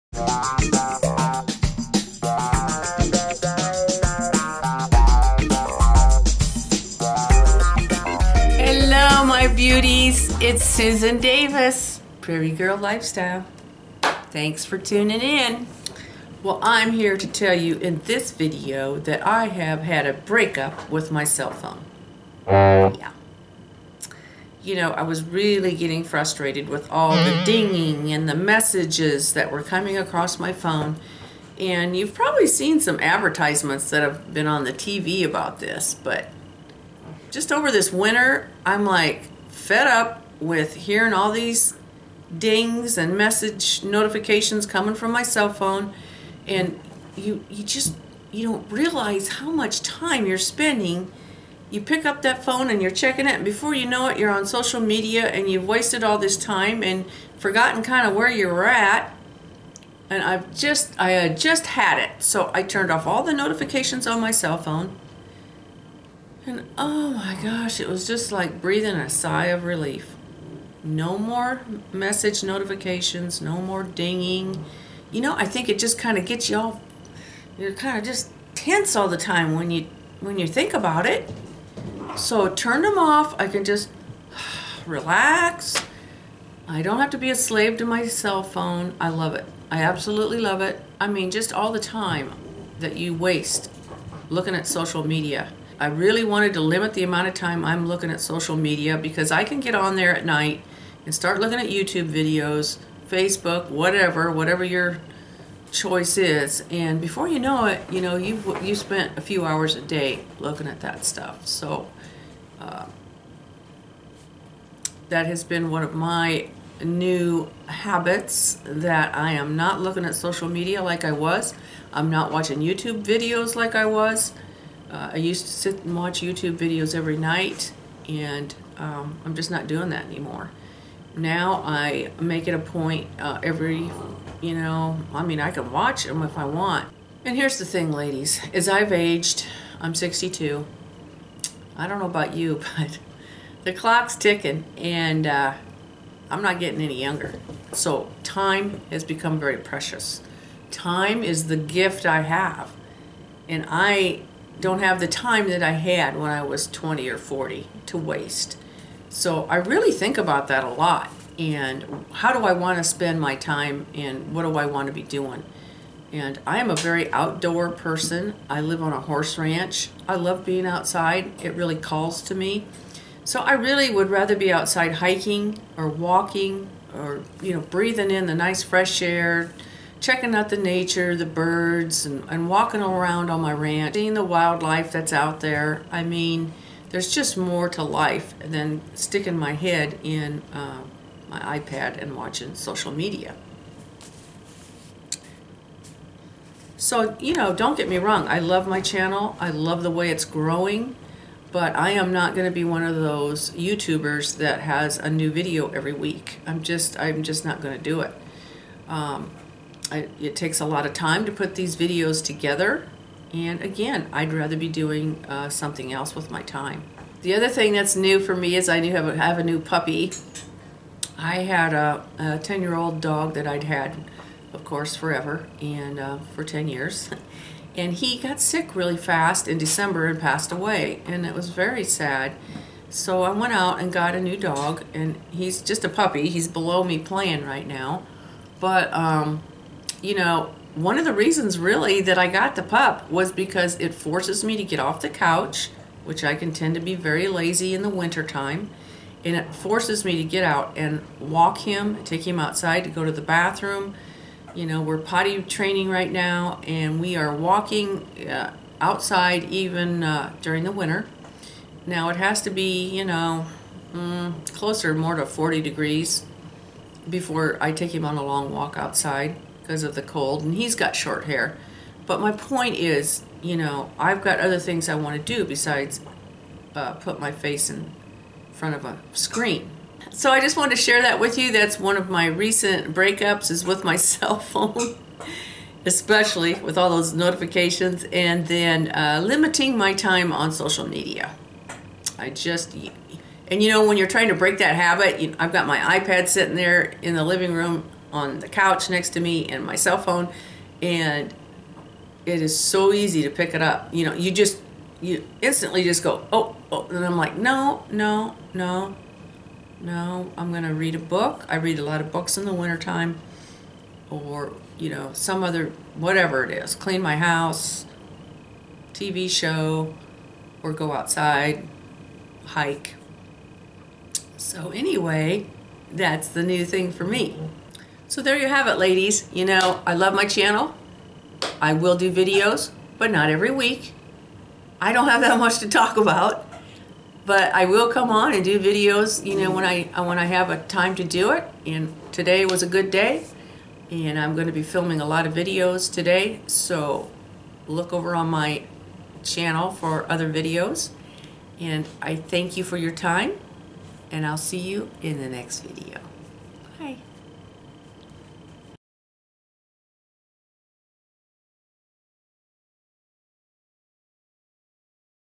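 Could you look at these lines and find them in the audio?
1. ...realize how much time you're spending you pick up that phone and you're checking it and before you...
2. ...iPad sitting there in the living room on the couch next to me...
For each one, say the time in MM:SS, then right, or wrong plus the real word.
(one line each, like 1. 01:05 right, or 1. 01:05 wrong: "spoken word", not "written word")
1. 00:48 right
2. 04:55 right.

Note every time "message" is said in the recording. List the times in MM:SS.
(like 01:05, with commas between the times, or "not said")
00:28, 00:43, 01:11.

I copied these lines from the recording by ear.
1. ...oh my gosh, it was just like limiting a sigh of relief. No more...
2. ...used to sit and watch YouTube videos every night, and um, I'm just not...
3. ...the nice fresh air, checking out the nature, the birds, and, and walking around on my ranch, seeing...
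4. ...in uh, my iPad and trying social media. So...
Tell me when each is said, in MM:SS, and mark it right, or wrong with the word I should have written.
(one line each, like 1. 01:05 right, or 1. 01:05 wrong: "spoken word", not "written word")
1. 01:06 wrong: "breathing", not "limiting"
2. 02:05 right
3. 02:58 right
4. 03:10 wrong: "watching", not "trying".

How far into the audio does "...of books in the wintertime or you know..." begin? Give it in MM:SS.
05:12.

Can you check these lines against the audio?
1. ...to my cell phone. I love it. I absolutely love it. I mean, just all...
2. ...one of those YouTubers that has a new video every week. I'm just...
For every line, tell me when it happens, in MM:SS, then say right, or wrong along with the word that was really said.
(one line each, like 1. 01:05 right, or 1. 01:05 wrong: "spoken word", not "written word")
1. 01:27 right
2. 03:22 right.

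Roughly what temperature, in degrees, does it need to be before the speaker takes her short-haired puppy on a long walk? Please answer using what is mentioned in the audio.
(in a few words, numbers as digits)
40 degrees.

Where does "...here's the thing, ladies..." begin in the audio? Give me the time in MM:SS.
02:17.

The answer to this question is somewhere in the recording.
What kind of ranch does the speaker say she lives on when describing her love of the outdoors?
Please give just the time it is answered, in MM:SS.
02:49.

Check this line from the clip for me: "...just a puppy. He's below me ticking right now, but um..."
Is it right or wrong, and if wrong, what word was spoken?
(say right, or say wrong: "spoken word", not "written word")
wrong: "playing", not "ticking".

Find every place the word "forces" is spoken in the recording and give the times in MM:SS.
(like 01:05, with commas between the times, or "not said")
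04:03, 04:09.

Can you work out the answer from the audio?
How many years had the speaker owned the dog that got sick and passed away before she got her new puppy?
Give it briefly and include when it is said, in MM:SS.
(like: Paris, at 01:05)
10, at 03:46.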